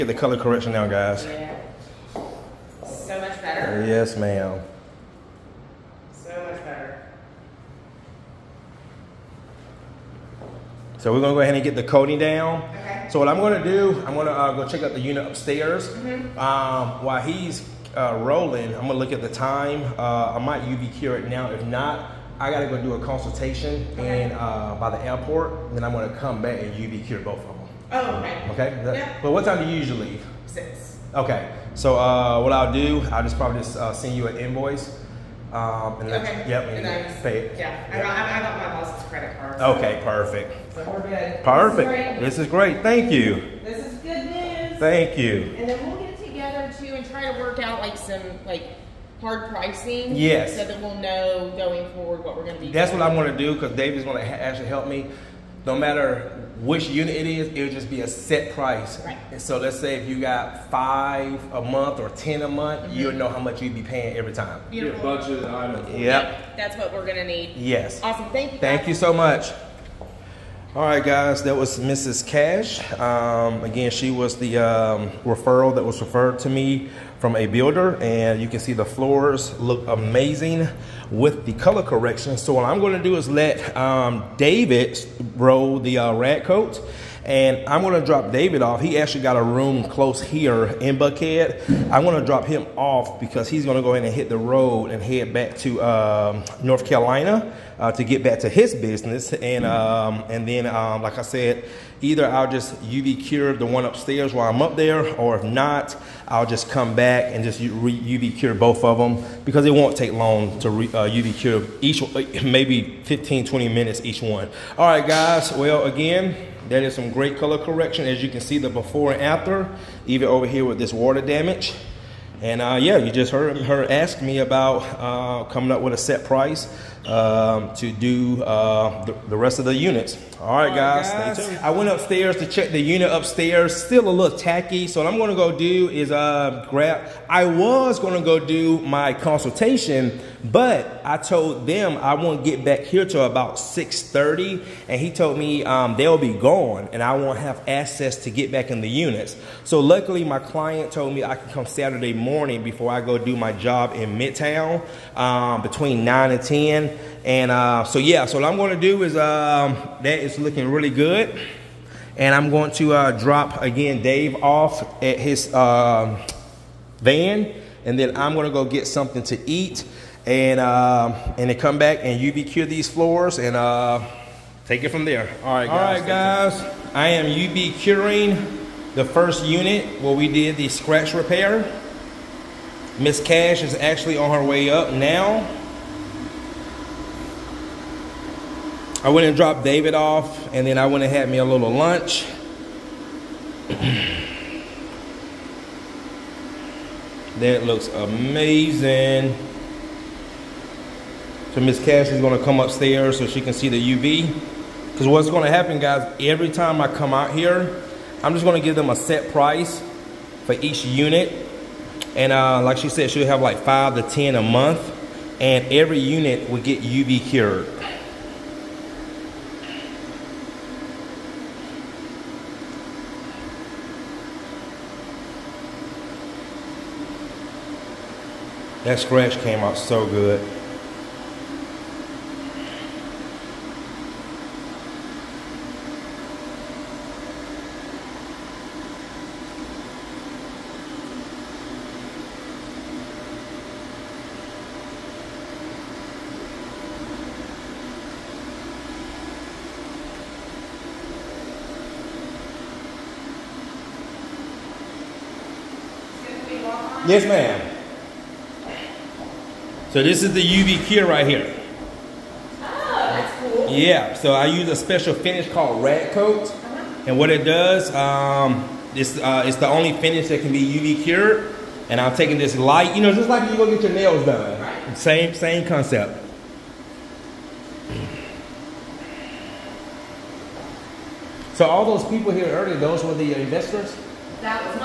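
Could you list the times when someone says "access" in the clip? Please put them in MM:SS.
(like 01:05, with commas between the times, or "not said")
02:27.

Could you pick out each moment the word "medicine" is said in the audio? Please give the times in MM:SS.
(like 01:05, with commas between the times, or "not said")
not said.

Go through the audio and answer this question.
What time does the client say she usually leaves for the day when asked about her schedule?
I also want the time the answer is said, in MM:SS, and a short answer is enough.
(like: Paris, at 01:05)
6, at 00:30.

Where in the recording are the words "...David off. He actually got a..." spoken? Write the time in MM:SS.
01:28.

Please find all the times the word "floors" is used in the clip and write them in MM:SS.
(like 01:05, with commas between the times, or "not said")
01:18, 02:52.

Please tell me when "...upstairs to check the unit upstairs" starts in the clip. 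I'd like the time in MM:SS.
02:11.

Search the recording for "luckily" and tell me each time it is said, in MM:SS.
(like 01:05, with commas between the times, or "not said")
02:29.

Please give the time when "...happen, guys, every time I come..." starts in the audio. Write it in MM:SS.
03:25.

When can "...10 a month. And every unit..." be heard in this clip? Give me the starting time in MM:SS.
03:34.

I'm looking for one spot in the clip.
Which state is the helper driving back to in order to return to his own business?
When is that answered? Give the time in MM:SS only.
01:36.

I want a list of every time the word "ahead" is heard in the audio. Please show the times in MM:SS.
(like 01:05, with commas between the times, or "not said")
00:11, 01:33.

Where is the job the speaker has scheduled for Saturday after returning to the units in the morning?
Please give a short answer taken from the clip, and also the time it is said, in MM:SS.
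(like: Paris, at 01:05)
Midtown, at 02:34.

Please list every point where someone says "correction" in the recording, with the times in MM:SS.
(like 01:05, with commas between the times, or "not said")
00:00, 01:21, 01:57.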